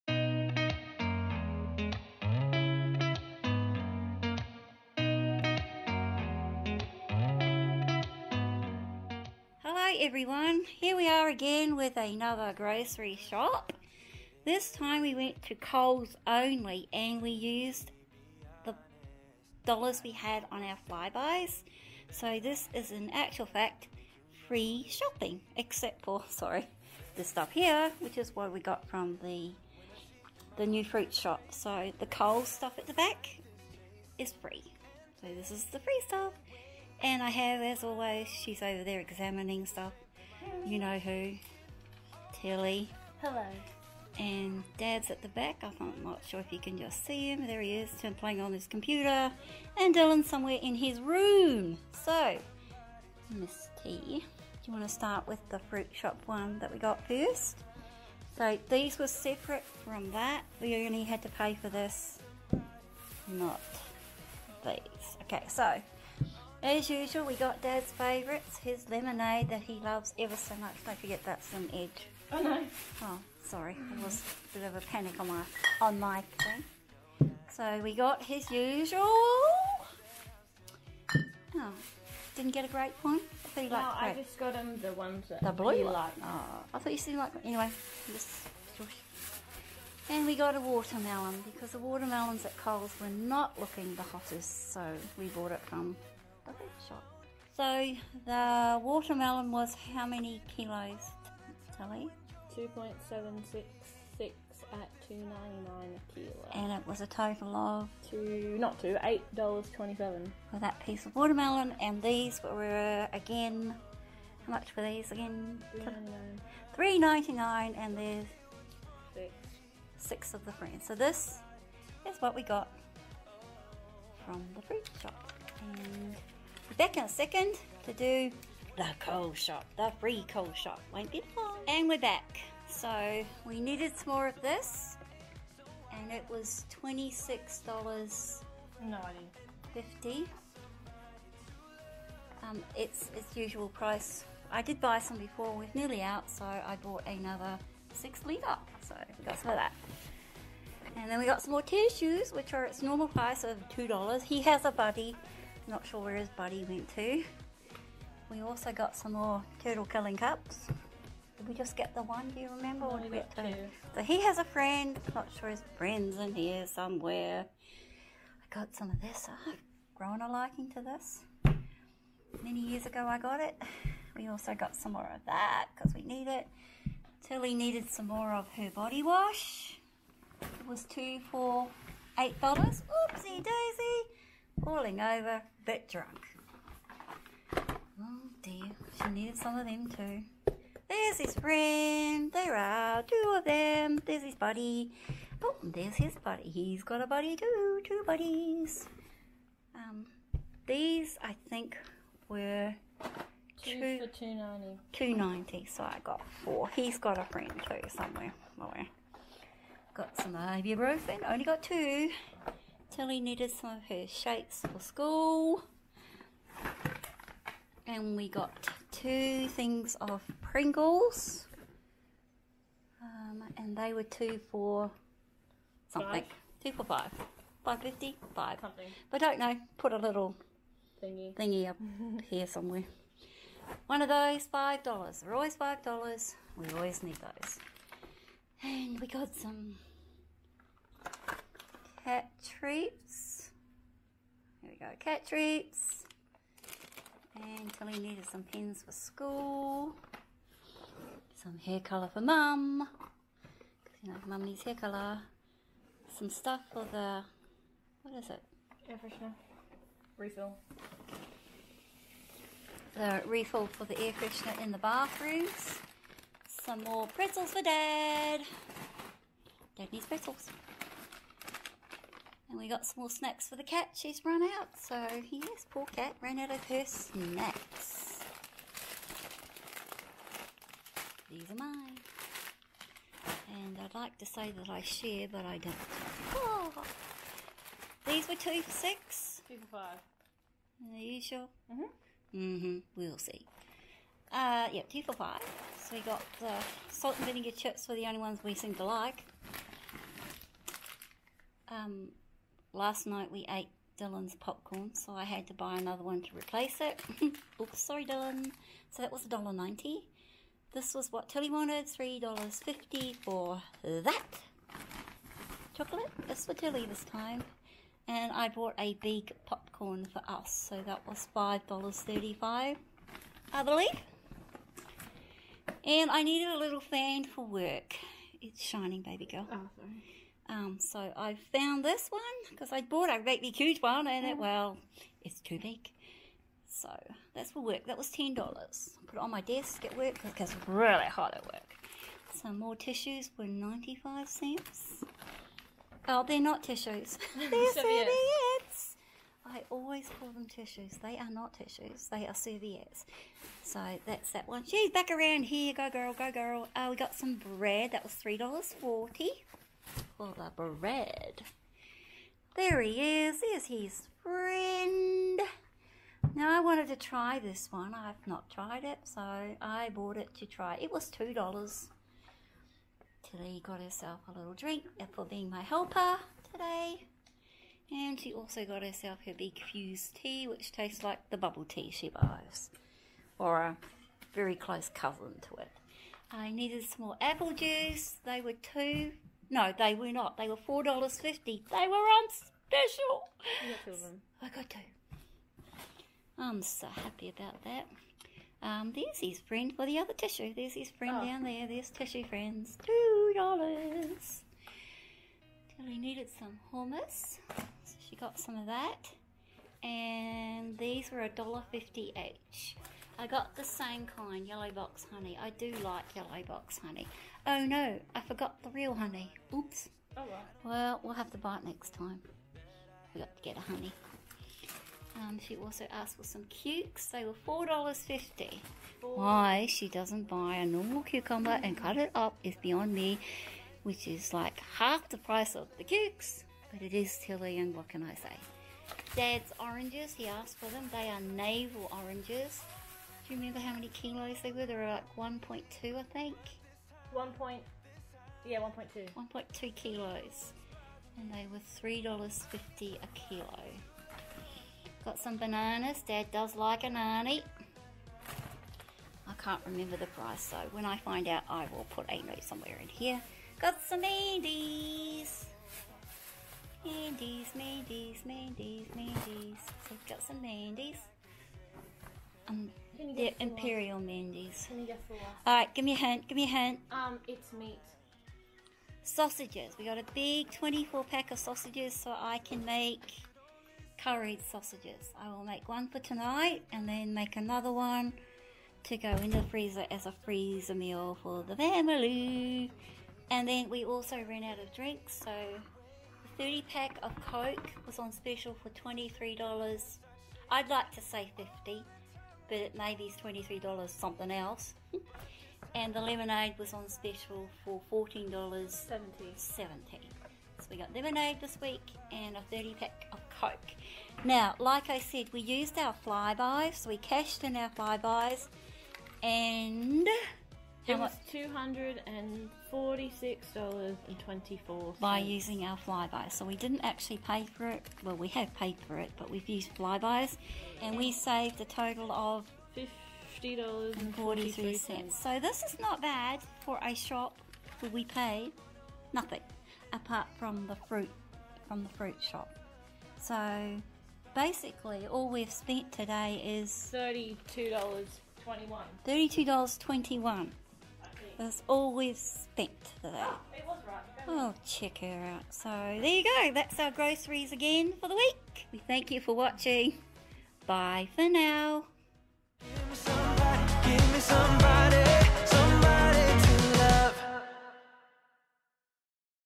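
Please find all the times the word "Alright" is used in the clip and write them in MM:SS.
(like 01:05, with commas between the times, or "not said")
07:55.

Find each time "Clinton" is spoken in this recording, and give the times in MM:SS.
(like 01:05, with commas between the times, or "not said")
not said.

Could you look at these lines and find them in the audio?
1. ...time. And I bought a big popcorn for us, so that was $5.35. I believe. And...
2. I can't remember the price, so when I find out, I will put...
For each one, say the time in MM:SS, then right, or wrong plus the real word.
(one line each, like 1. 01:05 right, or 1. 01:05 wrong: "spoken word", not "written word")
1. 05:17 right
2. 07:39 right.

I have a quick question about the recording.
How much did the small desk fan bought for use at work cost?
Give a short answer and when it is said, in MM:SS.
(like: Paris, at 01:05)
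$10, at 05:38.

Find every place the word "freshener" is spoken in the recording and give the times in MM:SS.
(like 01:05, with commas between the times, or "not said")
04:19, 04:24.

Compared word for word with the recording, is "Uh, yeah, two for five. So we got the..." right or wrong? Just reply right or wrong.
right.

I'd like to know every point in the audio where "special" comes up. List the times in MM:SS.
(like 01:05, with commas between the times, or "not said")
06:32, 08:18, 08:26.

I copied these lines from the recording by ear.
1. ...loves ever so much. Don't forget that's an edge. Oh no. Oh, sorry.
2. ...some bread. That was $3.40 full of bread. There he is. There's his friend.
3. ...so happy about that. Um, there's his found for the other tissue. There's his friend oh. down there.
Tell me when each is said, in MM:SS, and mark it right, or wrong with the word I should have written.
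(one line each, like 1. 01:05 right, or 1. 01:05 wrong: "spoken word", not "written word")
1. 01:09 right
2. 05:57 right
3. 06:36 wrong: "friend", not "found".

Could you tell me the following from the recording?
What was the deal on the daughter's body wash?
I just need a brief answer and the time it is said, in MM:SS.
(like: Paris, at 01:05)
2 for $8, at 03:00.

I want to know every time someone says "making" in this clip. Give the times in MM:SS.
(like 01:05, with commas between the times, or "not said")
not said.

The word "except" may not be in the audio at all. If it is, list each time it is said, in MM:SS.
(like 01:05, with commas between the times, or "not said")
00:25.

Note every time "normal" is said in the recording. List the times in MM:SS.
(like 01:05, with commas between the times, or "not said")
02:32, 07:10.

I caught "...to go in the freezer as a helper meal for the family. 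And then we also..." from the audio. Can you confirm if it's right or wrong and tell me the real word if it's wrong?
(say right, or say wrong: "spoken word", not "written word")
wrong: "freezer", not "helper".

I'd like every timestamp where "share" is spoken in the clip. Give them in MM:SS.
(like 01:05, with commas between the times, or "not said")
04:44.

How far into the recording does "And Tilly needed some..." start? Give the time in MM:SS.
04:07.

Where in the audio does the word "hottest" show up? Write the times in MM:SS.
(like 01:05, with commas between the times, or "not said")
01:34.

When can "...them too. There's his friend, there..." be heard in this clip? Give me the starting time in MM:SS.
03:09.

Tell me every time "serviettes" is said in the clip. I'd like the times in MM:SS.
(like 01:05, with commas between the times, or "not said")
05:47, 05:52.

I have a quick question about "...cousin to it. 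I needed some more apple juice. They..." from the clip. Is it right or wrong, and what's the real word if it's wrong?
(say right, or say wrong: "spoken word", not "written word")
right.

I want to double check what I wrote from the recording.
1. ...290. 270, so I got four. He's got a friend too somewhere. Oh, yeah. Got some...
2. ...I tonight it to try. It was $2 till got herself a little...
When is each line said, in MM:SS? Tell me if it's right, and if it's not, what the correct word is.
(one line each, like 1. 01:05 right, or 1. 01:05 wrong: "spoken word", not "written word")
1. 03:24 wrong: "290", not "270"
2. 06:09 wrong: "bought", not "tonight".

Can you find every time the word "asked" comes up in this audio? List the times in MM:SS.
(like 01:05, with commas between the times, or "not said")
07:05, 07:20.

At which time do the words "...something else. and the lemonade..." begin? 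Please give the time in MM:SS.
08:23.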